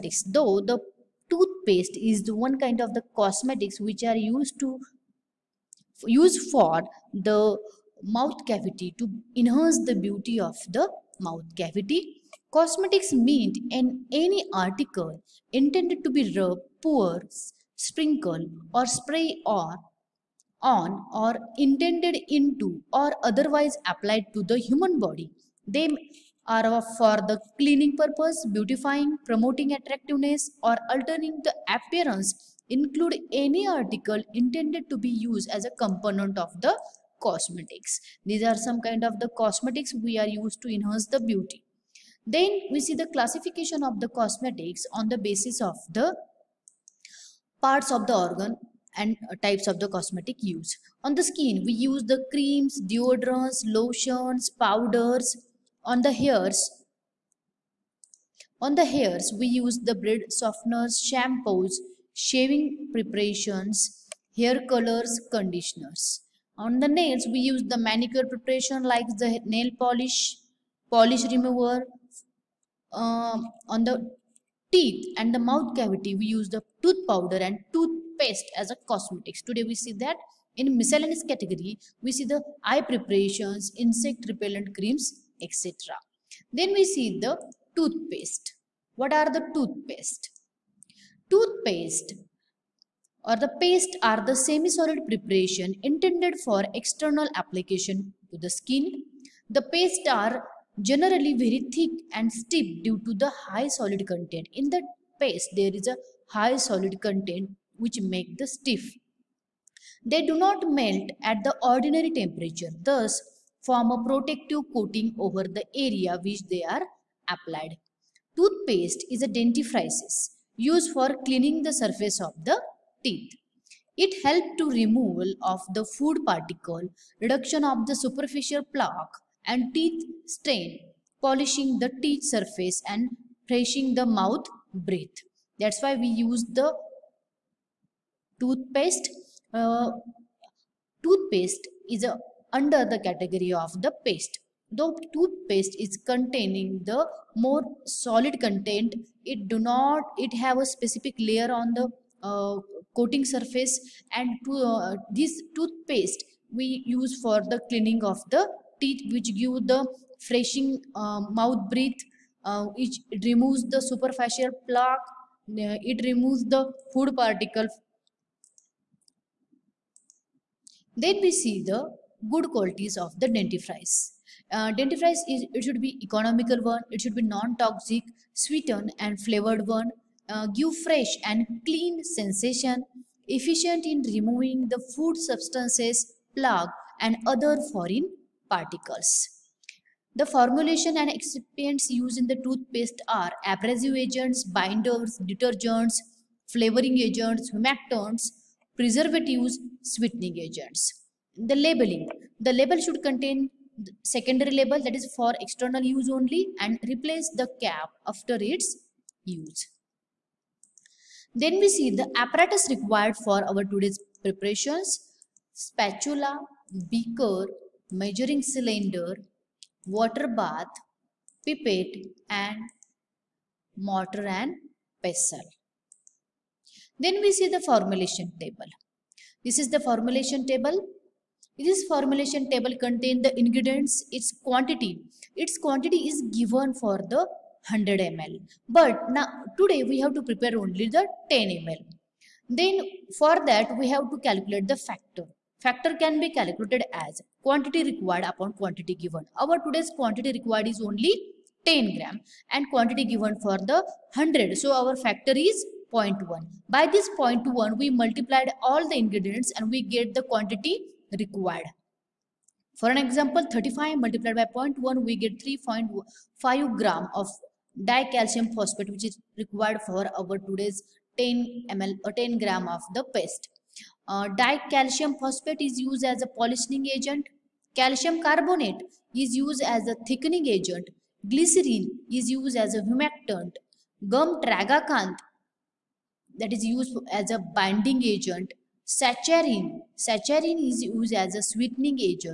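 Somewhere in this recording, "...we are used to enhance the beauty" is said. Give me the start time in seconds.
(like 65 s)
39 s.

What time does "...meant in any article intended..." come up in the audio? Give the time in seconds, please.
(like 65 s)
13 s.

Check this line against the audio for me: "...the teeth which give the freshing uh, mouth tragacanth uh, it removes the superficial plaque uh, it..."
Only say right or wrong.
wrong.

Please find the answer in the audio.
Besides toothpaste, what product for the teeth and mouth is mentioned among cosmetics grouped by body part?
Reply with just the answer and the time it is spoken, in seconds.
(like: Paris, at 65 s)
tooth powder, at 76 s.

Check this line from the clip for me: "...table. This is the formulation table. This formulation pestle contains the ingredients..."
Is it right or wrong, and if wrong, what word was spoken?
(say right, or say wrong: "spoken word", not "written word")
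wrong: "table", not "pestle".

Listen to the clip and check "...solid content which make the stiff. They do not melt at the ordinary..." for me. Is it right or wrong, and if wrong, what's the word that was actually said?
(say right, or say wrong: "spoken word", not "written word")
right.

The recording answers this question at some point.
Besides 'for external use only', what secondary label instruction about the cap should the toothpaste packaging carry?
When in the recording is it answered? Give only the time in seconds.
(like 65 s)
206 s.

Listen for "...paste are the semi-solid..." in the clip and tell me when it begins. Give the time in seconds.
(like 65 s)
93 s.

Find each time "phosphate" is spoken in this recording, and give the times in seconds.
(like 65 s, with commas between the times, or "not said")
268 s, 275 s.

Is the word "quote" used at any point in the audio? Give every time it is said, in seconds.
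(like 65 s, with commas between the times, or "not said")
not said.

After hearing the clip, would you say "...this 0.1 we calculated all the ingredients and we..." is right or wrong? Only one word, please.
wrong.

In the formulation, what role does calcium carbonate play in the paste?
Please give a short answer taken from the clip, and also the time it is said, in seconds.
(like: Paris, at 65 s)
thickening agent, at 280 s.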